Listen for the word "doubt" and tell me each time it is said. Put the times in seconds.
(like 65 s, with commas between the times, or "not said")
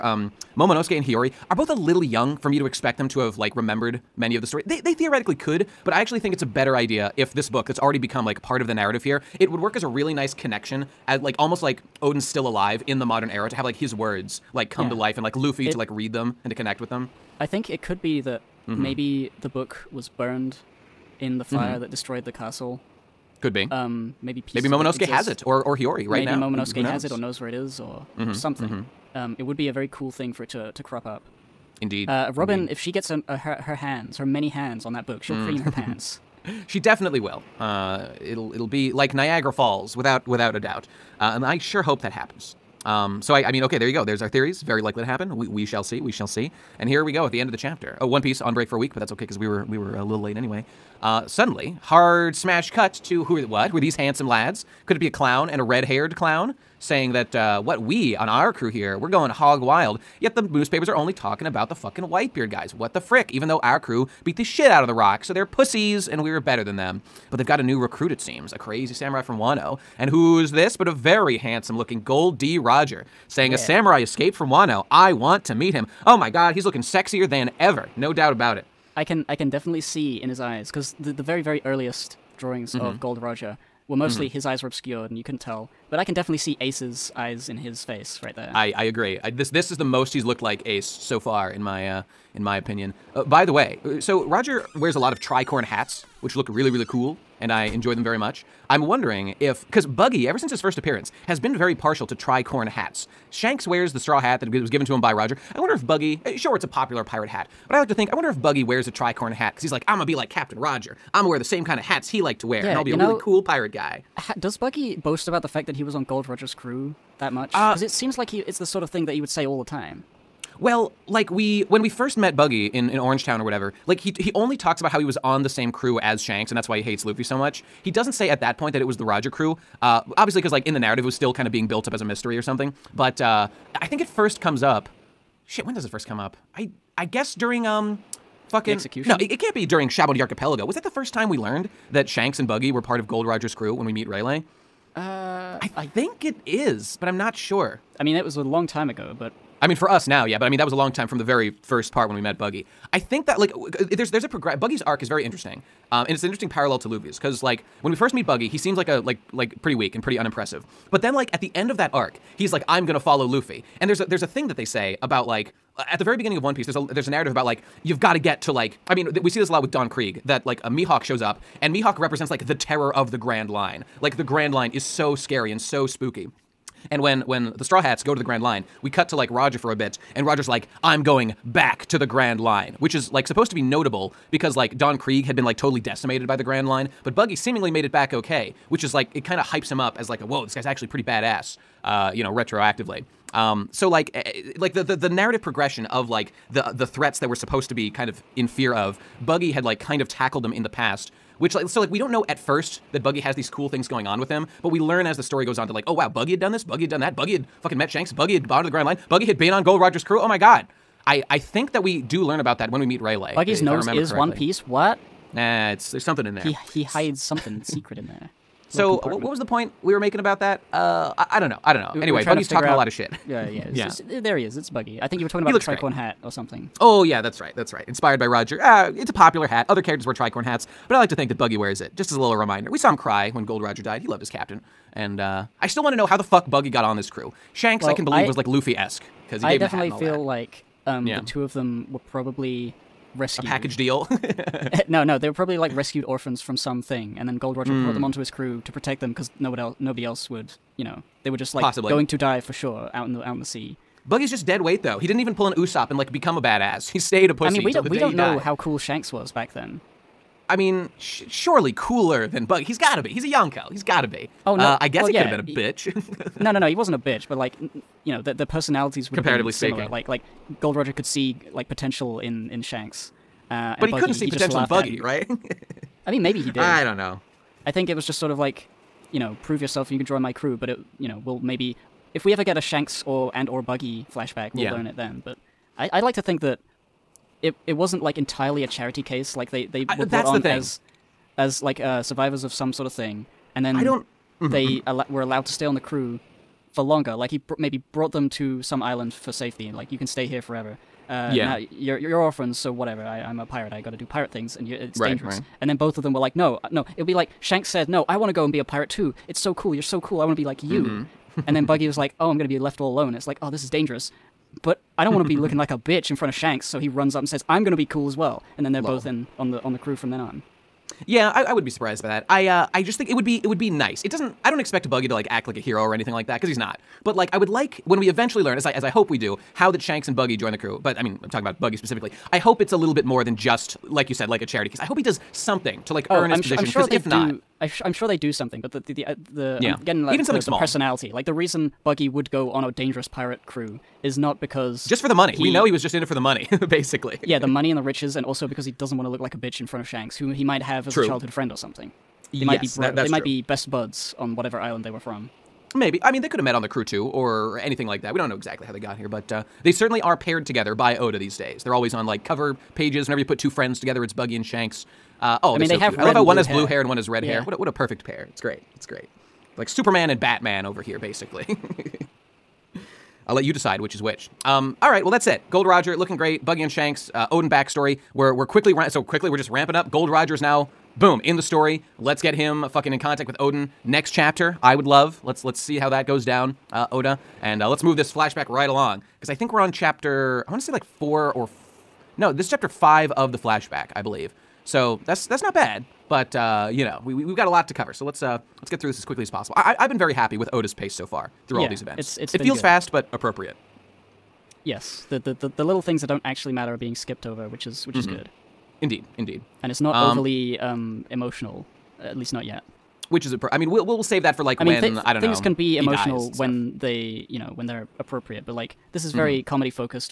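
40 s, 78 s.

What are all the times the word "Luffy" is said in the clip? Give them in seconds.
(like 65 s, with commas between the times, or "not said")
15 s, 127 s, 156 s, 163 s, 238 s.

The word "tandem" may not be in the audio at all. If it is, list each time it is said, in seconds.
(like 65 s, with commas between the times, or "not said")
not said.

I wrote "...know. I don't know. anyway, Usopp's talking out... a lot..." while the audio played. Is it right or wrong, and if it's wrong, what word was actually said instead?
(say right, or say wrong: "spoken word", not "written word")
wrong: "Buggy", not "Usopp".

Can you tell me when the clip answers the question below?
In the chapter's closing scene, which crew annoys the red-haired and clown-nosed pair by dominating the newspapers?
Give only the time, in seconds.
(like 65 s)
62 s.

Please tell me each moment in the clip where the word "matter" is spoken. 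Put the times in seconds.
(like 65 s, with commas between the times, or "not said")
406 s.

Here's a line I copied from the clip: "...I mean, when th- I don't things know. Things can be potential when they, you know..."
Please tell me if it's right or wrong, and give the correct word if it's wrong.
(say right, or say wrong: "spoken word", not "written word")
wrong: "emotional", not "potential".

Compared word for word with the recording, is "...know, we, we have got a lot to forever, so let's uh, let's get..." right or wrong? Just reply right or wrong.
wrong.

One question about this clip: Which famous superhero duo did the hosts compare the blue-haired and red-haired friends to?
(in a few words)
Superman and Batman.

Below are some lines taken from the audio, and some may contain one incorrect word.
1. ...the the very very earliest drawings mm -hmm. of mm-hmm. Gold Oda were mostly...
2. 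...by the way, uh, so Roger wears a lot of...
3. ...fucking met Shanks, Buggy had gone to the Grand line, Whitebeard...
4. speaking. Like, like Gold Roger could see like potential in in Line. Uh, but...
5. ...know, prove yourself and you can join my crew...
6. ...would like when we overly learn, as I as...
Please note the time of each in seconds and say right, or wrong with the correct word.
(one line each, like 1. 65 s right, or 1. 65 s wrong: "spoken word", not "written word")
1. 80 s wrong: "Roger", not "Oda"
2. 93 s right
3. 207 s wrong: "Buggy", not "Whitebeard"
4. 269 s wrong: "Shanks", not "Line"
5. 279 s right
6. 327 s wrong: "eventually", not "overly".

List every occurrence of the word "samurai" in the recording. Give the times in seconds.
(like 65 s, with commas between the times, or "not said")
68 s, 73 s.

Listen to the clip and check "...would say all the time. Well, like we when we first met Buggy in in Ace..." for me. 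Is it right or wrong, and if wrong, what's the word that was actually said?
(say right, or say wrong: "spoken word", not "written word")
wrong: "Orangetown", not "Ace".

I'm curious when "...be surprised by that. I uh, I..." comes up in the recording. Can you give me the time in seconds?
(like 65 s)
321 s.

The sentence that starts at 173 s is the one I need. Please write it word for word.
Like the Grand Line is so scary and so spooky.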